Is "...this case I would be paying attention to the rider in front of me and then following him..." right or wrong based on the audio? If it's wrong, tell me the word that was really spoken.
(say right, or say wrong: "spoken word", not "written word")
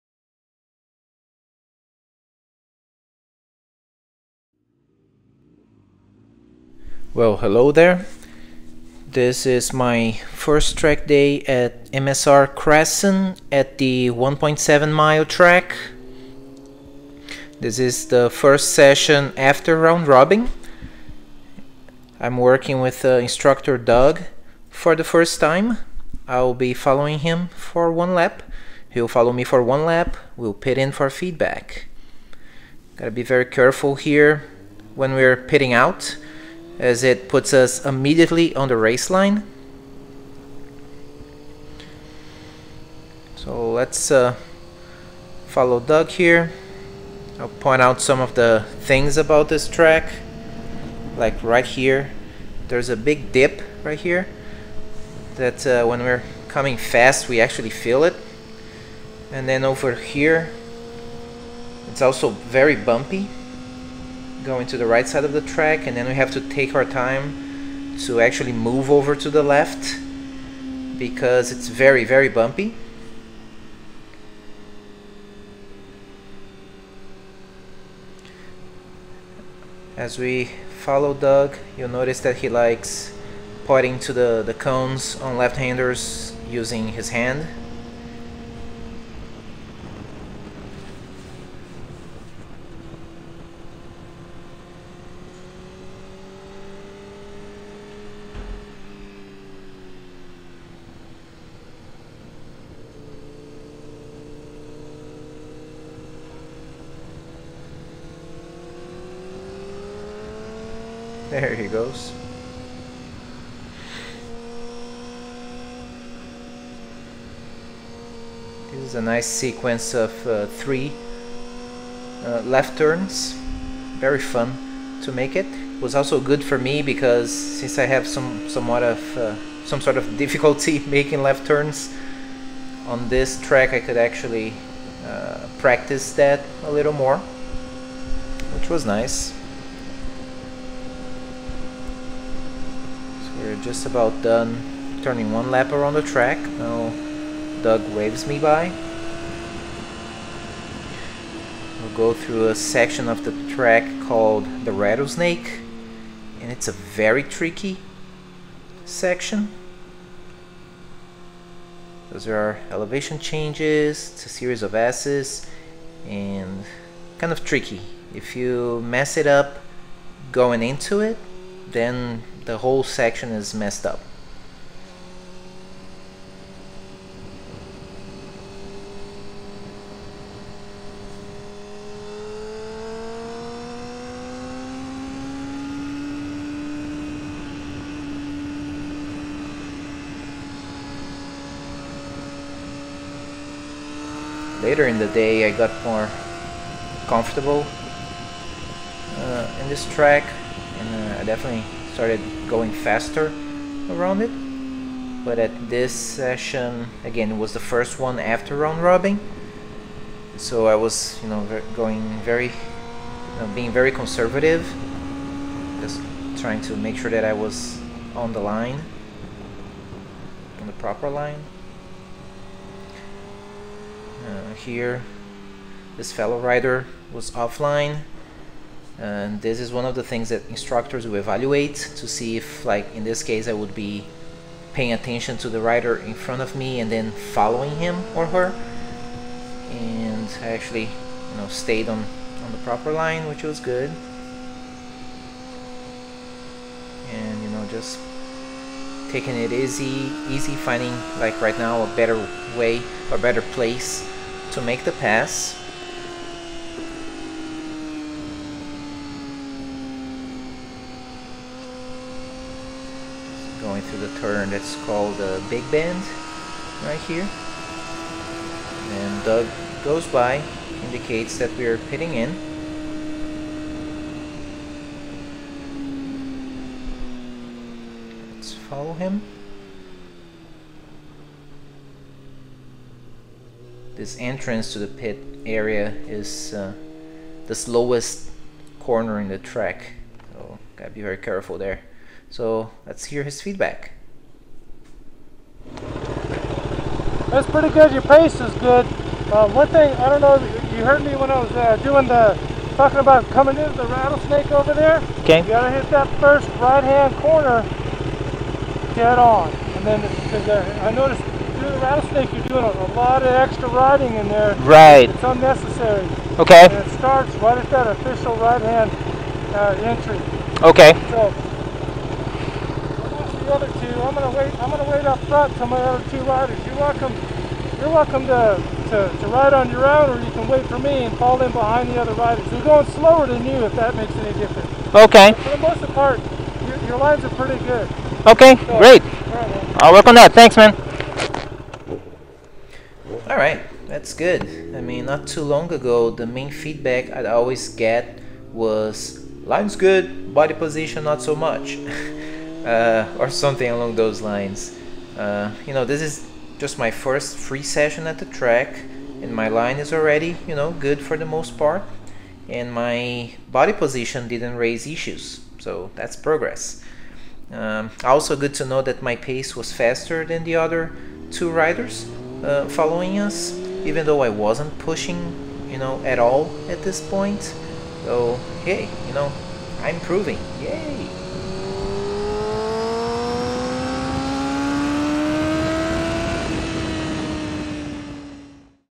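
right.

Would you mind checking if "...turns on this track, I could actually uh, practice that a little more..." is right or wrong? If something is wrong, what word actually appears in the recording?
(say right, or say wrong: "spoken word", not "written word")
right.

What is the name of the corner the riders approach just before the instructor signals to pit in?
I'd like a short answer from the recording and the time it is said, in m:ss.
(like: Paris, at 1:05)
Big Bend, at 4:25.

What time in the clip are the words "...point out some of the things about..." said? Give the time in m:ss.
0:47.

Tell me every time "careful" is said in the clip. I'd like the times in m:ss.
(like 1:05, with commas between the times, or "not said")
0:33, 4:51.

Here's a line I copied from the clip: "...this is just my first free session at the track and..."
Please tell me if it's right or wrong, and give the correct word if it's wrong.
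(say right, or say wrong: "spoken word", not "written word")
right.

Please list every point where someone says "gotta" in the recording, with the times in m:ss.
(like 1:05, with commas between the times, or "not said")
0:32, 4:50, 5:05.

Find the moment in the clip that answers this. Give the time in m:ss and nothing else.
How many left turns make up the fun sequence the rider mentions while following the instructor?
2:00.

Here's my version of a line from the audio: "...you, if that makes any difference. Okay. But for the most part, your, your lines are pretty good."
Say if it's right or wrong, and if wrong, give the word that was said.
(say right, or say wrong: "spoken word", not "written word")
right.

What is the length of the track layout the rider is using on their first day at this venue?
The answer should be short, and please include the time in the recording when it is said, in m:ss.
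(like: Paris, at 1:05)
1.7 miles, at 0:14.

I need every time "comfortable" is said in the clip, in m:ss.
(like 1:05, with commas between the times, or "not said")
3:17.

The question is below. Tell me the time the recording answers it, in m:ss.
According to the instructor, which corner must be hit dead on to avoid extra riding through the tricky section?
5:06.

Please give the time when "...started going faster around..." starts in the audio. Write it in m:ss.
3:22.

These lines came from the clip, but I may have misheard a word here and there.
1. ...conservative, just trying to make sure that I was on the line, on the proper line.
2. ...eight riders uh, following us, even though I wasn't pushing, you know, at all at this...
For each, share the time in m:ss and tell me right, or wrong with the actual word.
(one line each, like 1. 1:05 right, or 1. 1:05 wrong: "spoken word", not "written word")
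1. 3:33 right
2. 6:11 wrong: "two", not "eight".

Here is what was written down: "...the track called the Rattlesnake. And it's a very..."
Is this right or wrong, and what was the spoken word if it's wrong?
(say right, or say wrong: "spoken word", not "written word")
right.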